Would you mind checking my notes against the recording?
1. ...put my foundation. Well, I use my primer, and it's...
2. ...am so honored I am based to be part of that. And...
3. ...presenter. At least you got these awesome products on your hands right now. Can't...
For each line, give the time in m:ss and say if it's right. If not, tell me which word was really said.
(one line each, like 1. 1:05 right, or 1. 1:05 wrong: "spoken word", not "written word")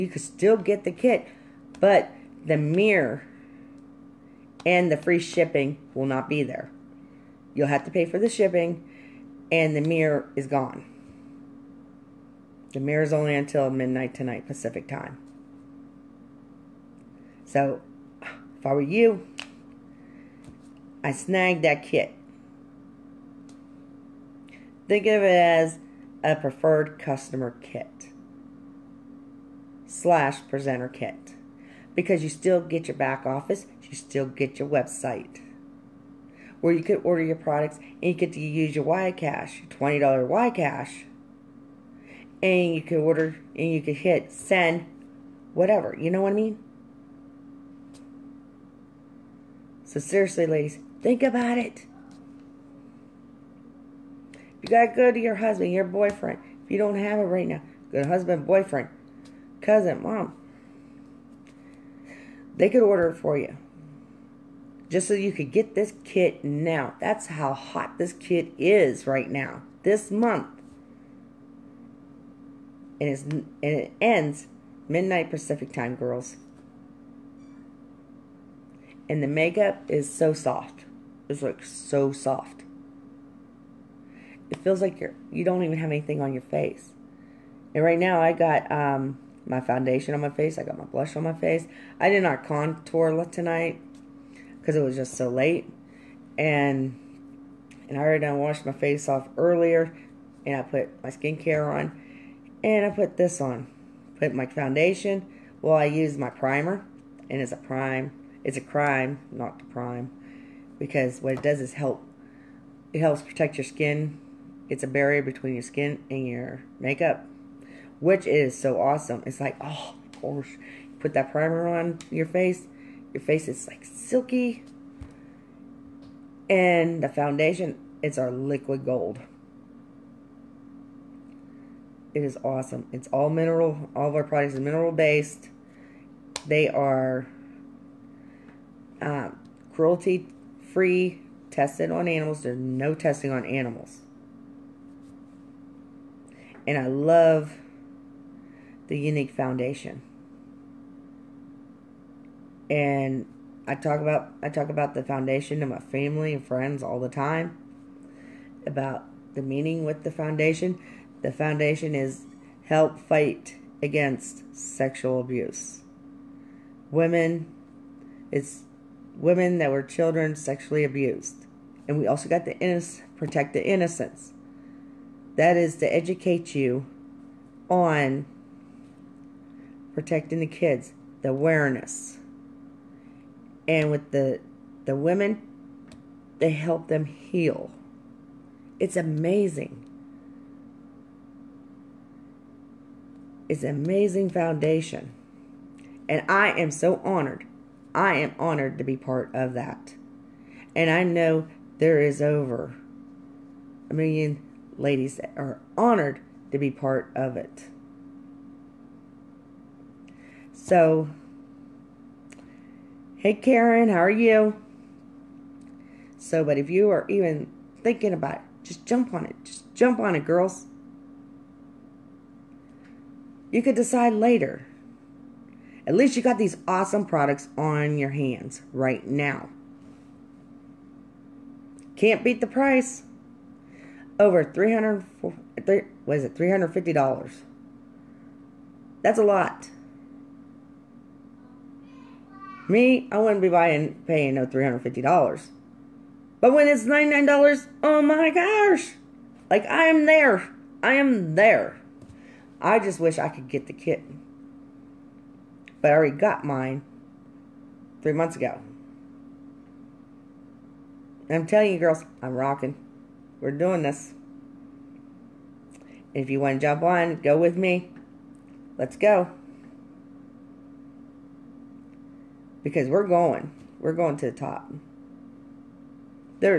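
1. 1:44 right
2. 3:16 wrong: "honored", not "based"
3. 3:44 wrong: "later", not "presenter".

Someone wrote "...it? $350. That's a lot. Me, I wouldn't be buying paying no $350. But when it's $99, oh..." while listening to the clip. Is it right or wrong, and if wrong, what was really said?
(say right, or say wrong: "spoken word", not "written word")
right.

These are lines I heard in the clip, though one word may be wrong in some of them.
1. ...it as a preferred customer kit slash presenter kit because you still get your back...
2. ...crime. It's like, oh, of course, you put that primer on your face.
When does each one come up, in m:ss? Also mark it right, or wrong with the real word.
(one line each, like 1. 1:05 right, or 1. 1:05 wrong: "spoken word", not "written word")
1. 0:25 right
2. 1:58 wrong: "awesome", not "crime".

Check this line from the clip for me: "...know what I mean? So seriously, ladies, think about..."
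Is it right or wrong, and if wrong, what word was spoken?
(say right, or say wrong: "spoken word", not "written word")
right.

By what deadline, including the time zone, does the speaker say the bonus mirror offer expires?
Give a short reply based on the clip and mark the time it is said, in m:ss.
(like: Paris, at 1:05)
Midnight tonight Pacific time, at 0:13.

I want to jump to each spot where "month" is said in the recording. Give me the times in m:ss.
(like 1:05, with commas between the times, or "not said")
1:10, 4:18.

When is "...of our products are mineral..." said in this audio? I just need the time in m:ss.
2:14.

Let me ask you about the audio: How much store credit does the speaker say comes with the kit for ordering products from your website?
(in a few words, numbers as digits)
$20.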